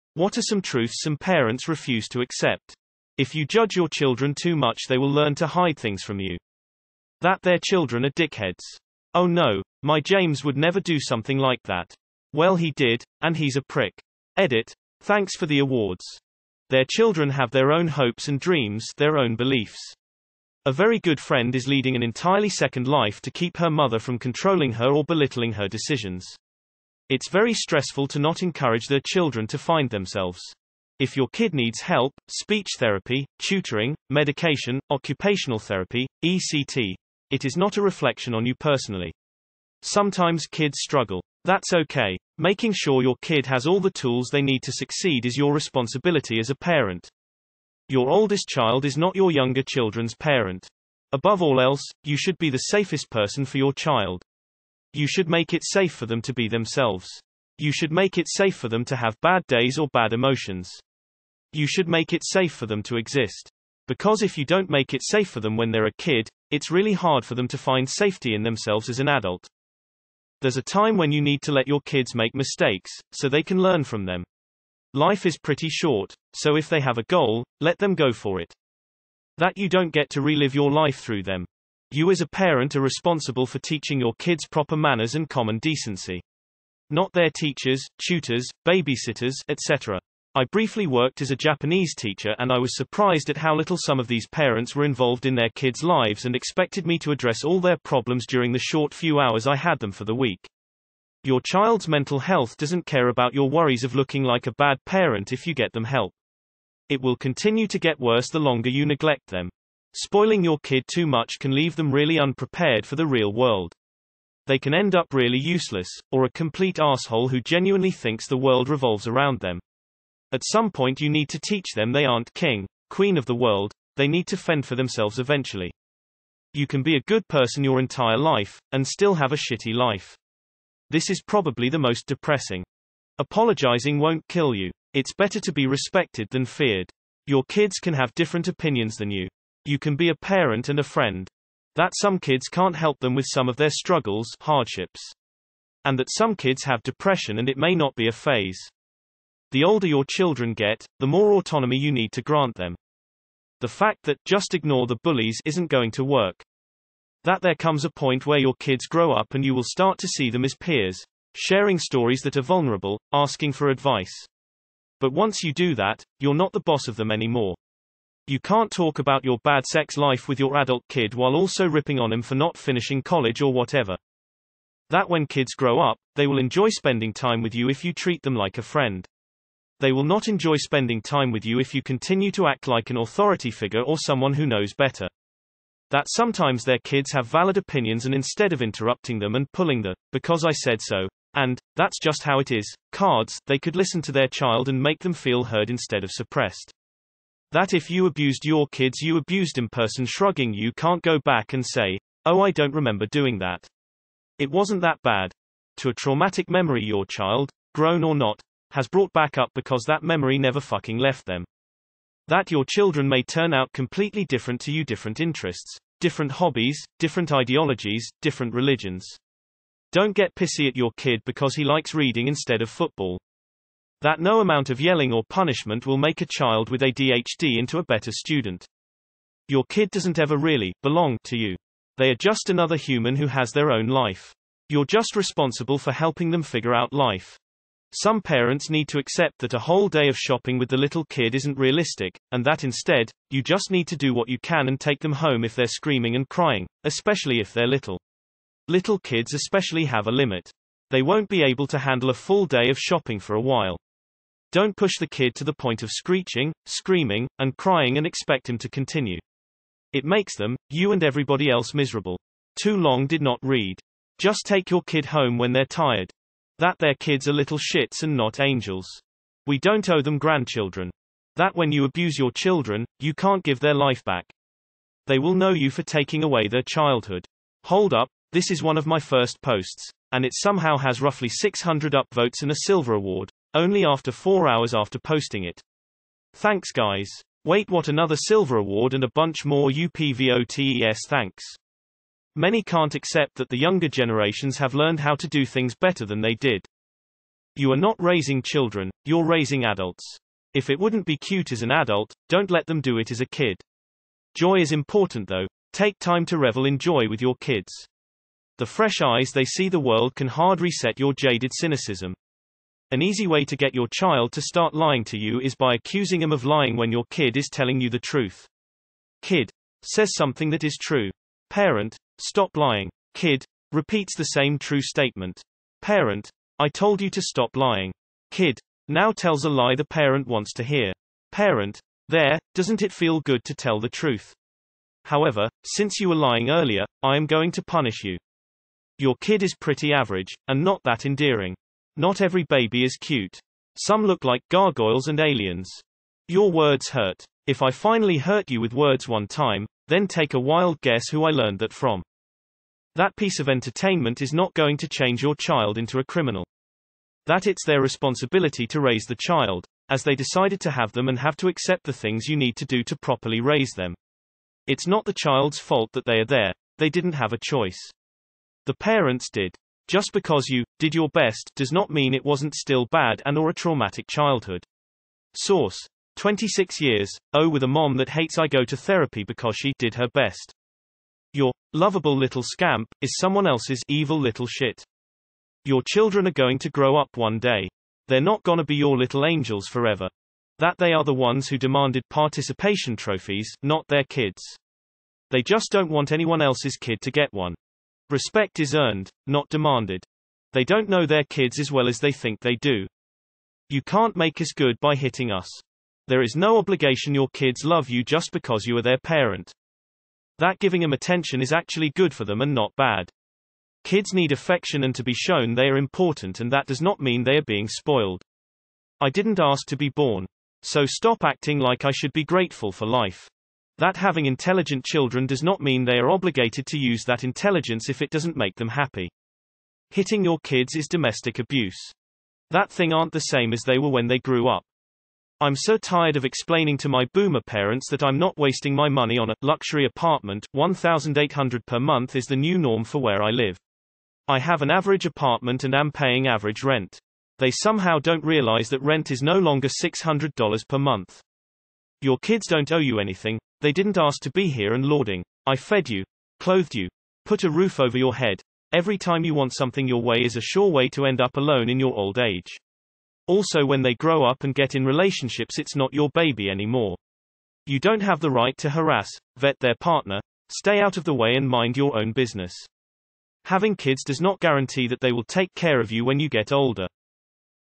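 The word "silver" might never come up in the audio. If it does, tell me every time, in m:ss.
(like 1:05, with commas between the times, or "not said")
4:42, 4:48.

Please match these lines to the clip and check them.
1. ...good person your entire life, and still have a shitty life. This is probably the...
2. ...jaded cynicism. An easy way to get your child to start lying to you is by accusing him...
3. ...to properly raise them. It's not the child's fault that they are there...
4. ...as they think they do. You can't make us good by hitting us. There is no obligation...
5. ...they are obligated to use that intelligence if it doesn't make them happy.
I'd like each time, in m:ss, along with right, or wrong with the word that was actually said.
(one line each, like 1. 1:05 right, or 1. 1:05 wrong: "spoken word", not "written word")
1. 2:07 right
2. 5:11 right
3. 6:02 right
4. 6:41 right
5. 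7:05 right.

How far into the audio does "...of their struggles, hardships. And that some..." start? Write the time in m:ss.
2:23.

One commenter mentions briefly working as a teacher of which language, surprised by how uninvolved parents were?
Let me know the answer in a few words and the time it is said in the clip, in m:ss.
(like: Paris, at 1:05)
Japanese, at 1:31.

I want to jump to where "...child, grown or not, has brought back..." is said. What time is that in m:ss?
3:27.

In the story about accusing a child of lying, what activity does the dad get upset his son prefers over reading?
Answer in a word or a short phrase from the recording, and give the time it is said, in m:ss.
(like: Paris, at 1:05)
football, at 3:42.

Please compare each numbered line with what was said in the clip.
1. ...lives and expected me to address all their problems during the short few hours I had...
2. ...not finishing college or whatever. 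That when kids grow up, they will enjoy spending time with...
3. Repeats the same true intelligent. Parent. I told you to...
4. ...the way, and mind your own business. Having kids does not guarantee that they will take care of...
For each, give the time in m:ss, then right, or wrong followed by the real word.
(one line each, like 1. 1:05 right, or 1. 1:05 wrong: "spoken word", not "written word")
1. 1:35 right
2. 2:52 right
3. 5:23 wrong: "statement", not "intelligent"
4. 7:51 right.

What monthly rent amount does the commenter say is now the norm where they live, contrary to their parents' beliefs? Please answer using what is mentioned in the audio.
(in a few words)
$1800.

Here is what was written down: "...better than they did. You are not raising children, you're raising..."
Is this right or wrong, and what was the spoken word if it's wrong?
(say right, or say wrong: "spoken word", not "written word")
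right.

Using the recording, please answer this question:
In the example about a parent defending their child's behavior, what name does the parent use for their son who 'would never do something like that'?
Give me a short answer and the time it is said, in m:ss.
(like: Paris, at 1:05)
James, at 0:10.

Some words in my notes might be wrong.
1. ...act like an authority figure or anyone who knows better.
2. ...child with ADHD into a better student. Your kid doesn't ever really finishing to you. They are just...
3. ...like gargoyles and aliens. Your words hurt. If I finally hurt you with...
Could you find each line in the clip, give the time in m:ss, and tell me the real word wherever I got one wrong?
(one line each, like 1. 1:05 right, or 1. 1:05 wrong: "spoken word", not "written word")
1. 3:02 wrong: "someone", not "anyone"
2. 3:46 wrong: "belong", not "finishing"
3. 5:44 right.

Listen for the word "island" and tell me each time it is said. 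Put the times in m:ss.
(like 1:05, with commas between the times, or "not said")
not said.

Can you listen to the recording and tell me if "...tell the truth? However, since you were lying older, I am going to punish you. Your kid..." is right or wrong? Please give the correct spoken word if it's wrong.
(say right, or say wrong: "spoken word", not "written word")
wrong: "earlier", not "older".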